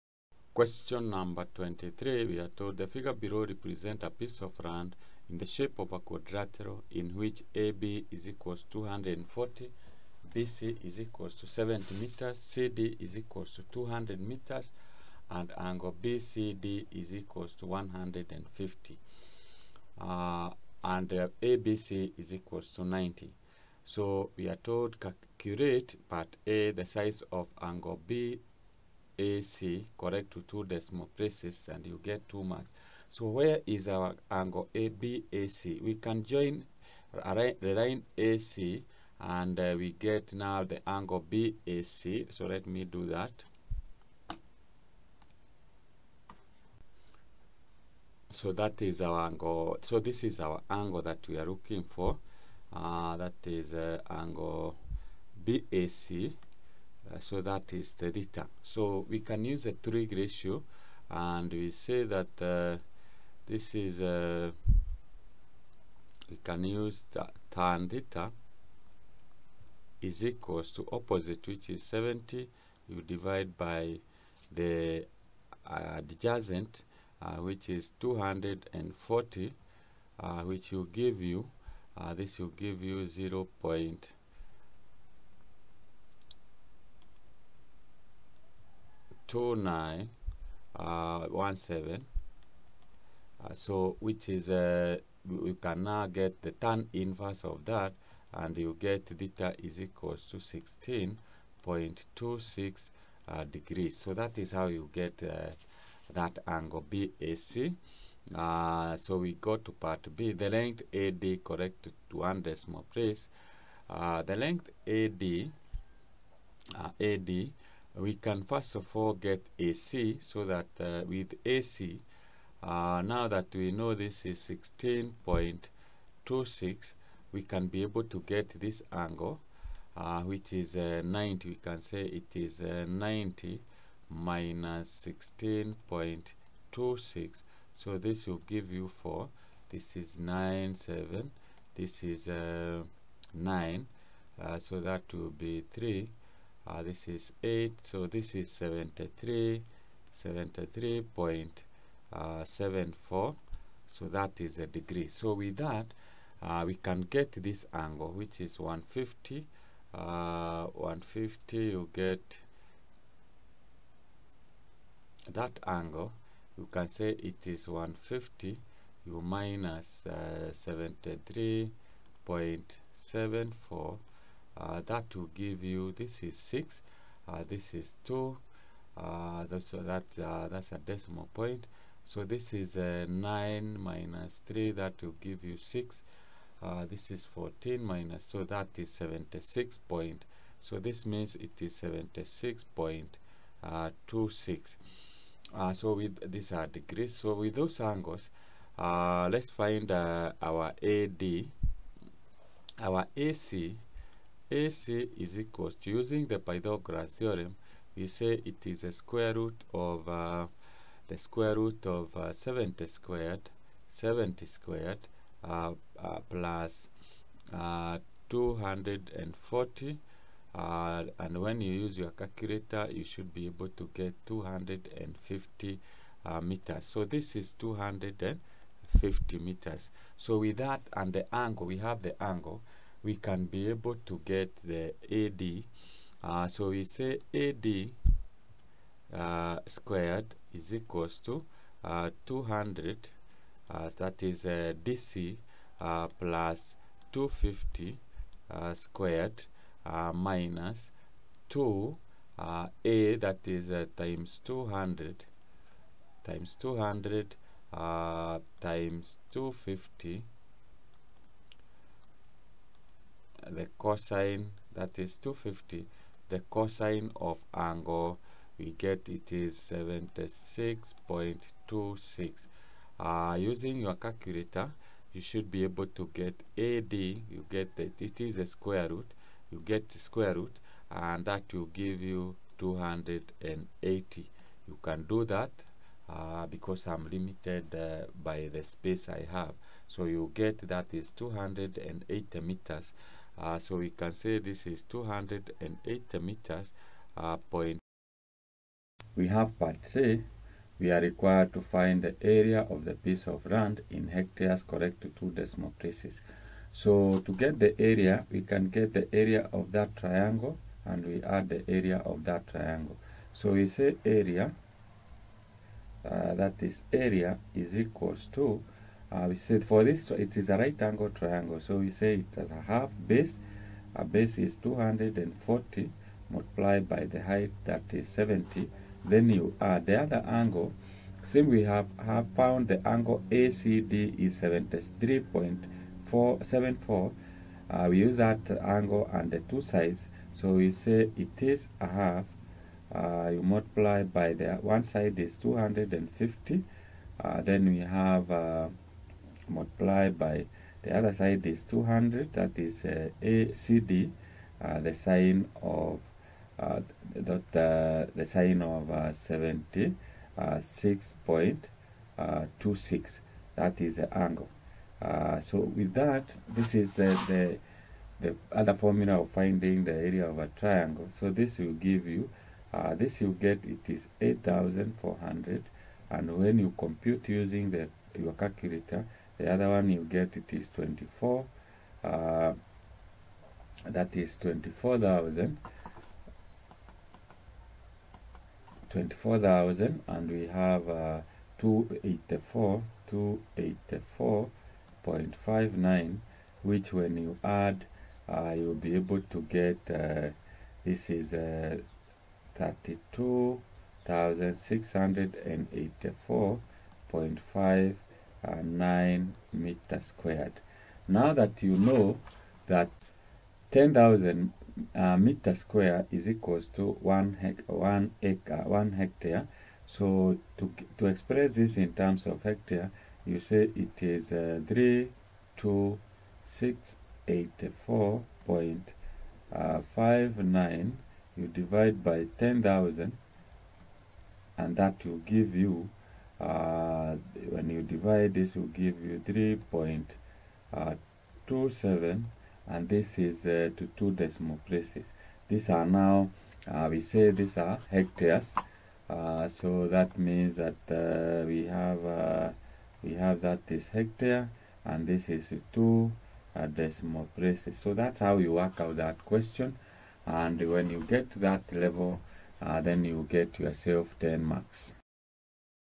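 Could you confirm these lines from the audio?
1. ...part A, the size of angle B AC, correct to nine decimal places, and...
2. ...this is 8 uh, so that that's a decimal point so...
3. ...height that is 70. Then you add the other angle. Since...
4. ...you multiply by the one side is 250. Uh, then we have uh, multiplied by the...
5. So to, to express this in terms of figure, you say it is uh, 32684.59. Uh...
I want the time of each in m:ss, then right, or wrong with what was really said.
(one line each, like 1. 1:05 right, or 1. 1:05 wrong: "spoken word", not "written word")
1. 0:26 wrong: "two", not "nine"
2. 2:57 wrong: "2", not "8"
3. 5:27 right
4. 5:43 right
5. 6:59 wrong: "hectare", not "figure".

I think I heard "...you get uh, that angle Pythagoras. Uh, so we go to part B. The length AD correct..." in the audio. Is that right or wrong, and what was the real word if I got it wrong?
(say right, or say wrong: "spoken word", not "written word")
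wrong: "BAC", not "Pythagoras".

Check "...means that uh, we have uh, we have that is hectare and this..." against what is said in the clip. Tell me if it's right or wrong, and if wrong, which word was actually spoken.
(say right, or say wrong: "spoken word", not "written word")
right.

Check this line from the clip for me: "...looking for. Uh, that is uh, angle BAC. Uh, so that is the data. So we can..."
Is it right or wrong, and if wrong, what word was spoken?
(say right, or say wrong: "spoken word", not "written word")
right.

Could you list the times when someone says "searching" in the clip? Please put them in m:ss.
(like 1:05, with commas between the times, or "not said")
not said.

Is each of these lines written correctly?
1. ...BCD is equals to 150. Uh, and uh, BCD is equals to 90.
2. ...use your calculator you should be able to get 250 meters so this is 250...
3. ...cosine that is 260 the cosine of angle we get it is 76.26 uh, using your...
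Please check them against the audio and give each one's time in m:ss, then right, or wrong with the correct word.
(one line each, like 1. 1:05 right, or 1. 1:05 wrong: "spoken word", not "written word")
1. 0:16 wrong: "ABC", not "BCD"
2. 3:41 right
3. 4:23 wrong: "250", not "260".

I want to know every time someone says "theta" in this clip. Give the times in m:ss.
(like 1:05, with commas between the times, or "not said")
1:07, 1:39.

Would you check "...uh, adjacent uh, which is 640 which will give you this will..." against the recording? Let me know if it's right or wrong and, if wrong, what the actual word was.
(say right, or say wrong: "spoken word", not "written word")
wrong: "240", not "640".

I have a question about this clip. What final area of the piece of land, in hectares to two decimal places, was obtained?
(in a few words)
3.27.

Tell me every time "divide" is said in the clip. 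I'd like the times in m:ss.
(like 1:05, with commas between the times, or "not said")
1:13, 7:11, 7:17.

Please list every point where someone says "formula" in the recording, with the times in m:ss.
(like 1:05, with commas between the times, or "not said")
6:08.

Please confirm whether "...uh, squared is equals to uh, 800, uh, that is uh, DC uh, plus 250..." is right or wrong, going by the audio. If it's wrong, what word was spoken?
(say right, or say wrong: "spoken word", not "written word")
wrong: "200", not "800".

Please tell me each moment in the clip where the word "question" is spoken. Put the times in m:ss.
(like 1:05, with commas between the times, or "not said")
0:00, 7:39.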